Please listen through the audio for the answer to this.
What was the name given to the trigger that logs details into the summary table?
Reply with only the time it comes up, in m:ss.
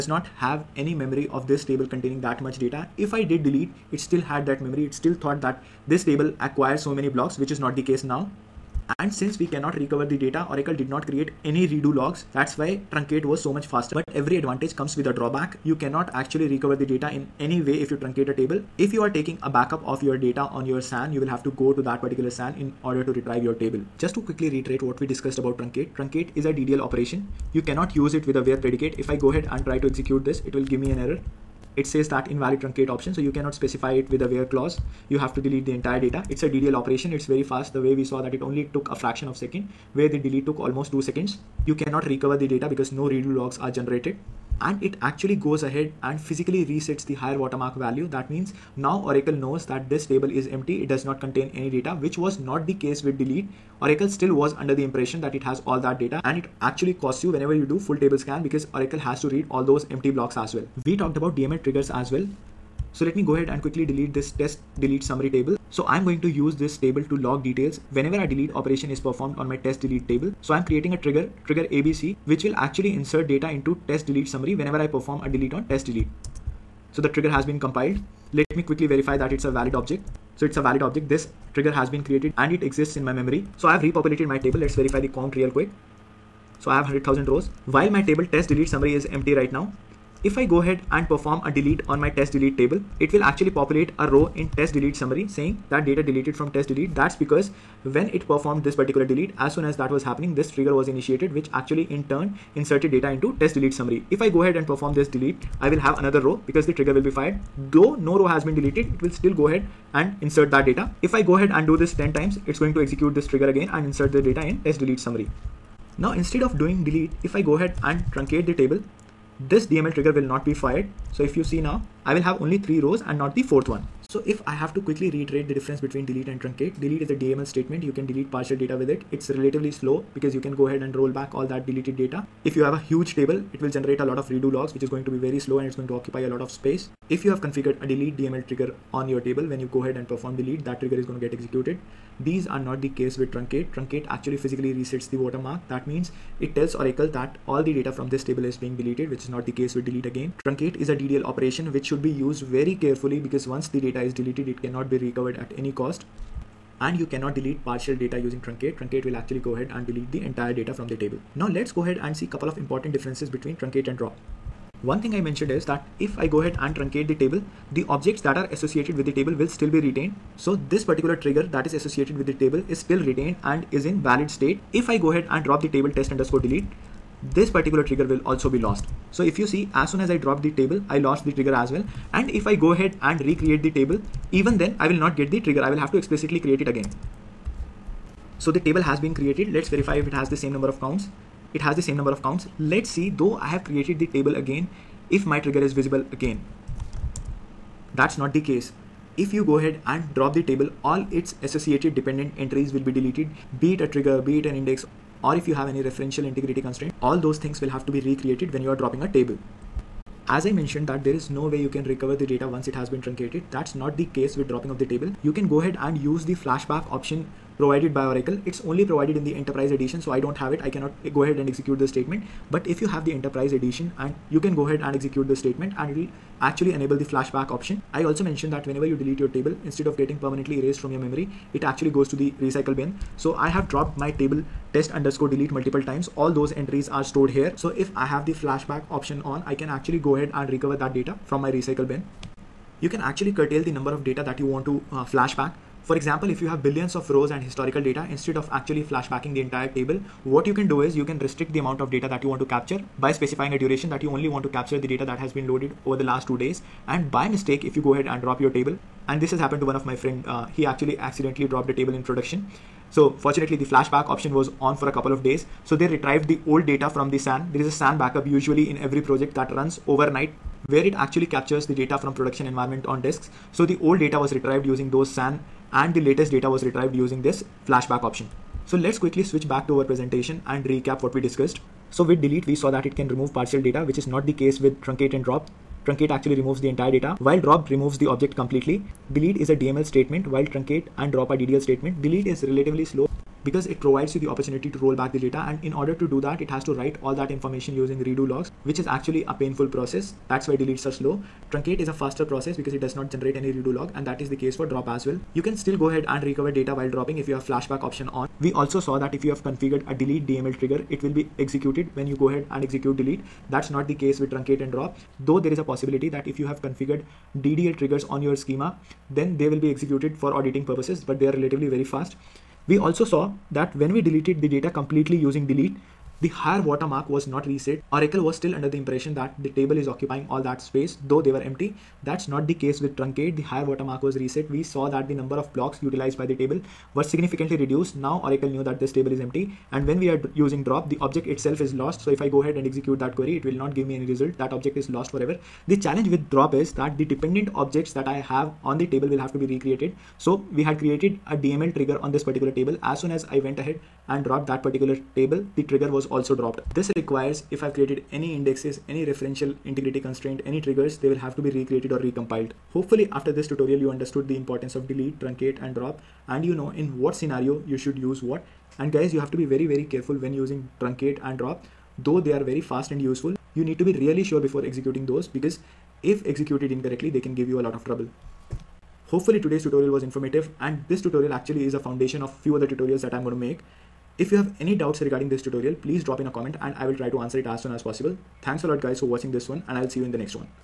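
1:11.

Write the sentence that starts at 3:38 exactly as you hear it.
It's only provided in the enterprise edition, so I don't have it.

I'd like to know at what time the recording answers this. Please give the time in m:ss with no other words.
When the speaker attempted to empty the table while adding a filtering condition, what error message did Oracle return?
0:32.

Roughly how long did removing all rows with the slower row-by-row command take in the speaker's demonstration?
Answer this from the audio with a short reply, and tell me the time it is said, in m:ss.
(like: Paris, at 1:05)
almost 2 seconds, at 0:40.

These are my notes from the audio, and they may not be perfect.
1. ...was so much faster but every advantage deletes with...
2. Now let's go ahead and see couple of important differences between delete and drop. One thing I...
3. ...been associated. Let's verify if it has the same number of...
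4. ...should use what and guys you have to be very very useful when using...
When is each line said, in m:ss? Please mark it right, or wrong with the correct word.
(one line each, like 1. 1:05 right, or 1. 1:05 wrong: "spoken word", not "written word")
1. 0:13 wrong: "comes", not "deletes"
2. 2:41 wrong: "truncate", not "delete"
3. 3:08 wrong: "created", not "associated"
4. 6:07 wrong: "careful", not "useful".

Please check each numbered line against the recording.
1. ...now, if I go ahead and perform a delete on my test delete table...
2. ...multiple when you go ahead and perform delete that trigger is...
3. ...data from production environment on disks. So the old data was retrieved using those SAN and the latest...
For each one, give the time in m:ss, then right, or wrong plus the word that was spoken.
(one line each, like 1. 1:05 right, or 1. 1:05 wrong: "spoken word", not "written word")
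1. 1:29 right
2. 2:19 wrong: "table", not "multiple"
3. 4:31 right.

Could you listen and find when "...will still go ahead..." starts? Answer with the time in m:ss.
1:49.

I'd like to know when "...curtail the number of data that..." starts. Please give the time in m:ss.
4:03.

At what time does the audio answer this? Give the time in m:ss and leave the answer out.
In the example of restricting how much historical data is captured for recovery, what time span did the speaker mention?
4:16.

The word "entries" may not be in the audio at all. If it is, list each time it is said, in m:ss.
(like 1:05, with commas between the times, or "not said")
3:22, 3:56.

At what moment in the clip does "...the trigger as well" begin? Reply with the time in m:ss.
3:01.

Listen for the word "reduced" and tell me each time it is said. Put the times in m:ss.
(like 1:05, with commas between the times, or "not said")
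5:37.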